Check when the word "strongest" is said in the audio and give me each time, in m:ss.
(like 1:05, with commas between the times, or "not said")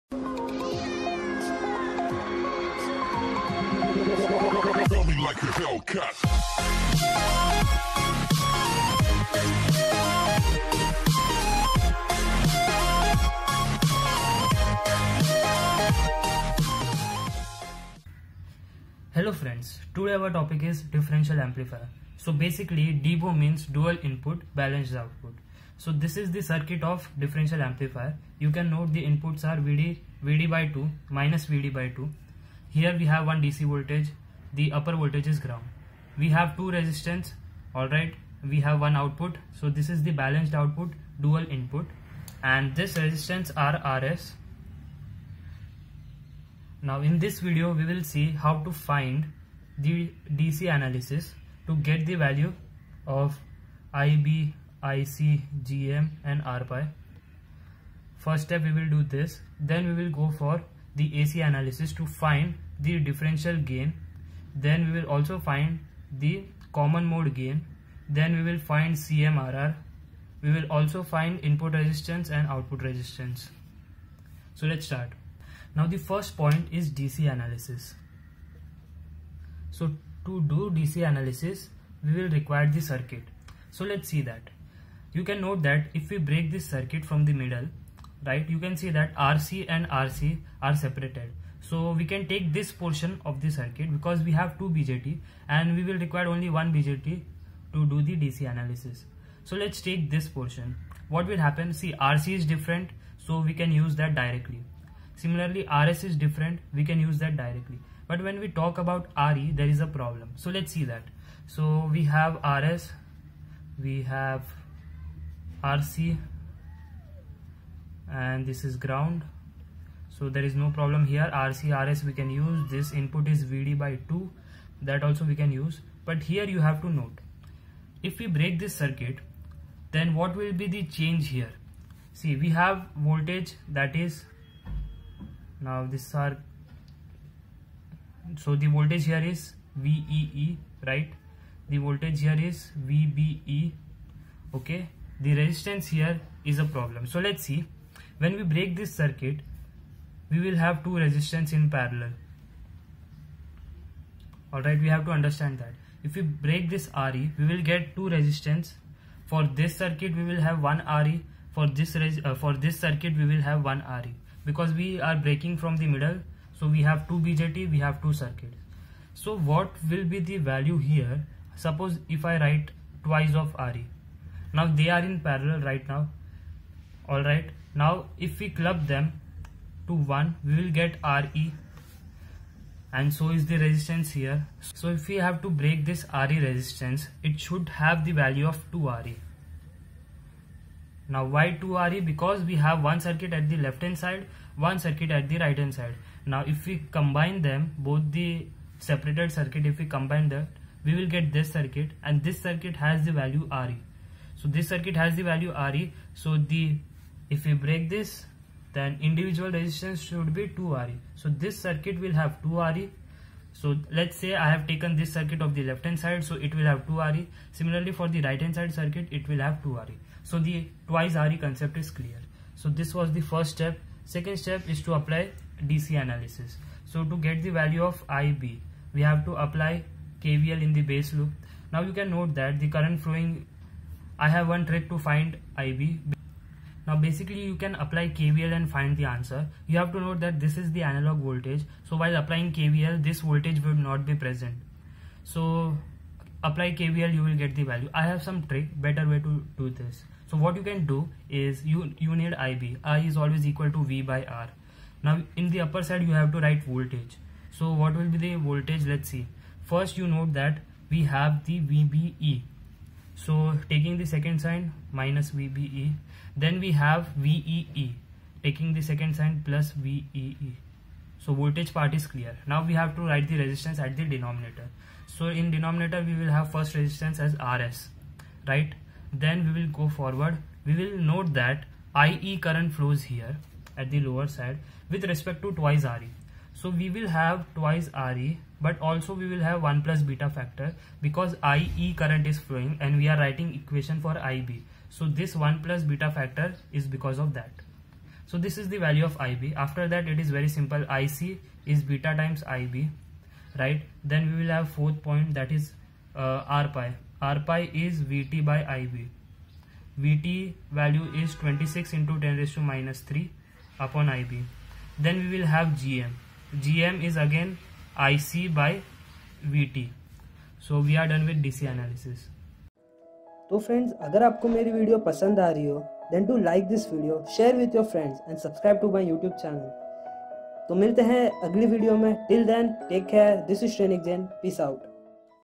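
not said.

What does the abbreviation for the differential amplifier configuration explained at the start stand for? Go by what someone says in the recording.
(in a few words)
dual input balanced output.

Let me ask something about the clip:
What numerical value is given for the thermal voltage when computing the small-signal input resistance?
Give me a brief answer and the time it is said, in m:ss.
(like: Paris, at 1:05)
26 × 10^-3, at 5:11.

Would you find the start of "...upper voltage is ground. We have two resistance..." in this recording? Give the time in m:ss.
0:34.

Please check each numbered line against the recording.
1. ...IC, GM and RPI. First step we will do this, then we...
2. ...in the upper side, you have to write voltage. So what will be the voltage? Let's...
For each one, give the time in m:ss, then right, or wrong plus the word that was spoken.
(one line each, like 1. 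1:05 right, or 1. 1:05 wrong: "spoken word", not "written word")
1. 0:54 right
2. 4:15 right.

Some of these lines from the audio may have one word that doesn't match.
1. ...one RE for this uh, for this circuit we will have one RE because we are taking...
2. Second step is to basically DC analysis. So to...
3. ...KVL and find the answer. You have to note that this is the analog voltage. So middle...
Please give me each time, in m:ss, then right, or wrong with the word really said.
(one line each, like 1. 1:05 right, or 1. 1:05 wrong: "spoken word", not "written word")
1. 2:40 wrong: "breaking", not "taking"
2. 3:44 wrong: "apply", not "basically"
3. 3:58 wrong: "while", not "middle".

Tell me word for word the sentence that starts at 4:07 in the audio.
I have some trick, better way to do this.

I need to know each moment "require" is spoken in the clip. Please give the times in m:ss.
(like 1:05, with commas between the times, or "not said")
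1:22, 1:35.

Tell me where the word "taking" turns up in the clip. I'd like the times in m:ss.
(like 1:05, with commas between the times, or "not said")
4:23, 4:28.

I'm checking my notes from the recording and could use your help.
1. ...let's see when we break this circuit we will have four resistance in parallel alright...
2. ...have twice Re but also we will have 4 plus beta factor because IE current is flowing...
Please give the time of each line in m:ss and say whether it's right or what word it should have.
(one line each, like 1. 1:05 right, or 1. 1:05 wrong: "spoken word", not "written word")
1. 2:27 wrong: "two", not "four"
2. 4:47 wrong: "1", not "4".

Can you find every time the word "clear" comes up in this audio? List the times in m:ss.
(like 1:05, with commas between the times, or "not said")
3:41, 4:32.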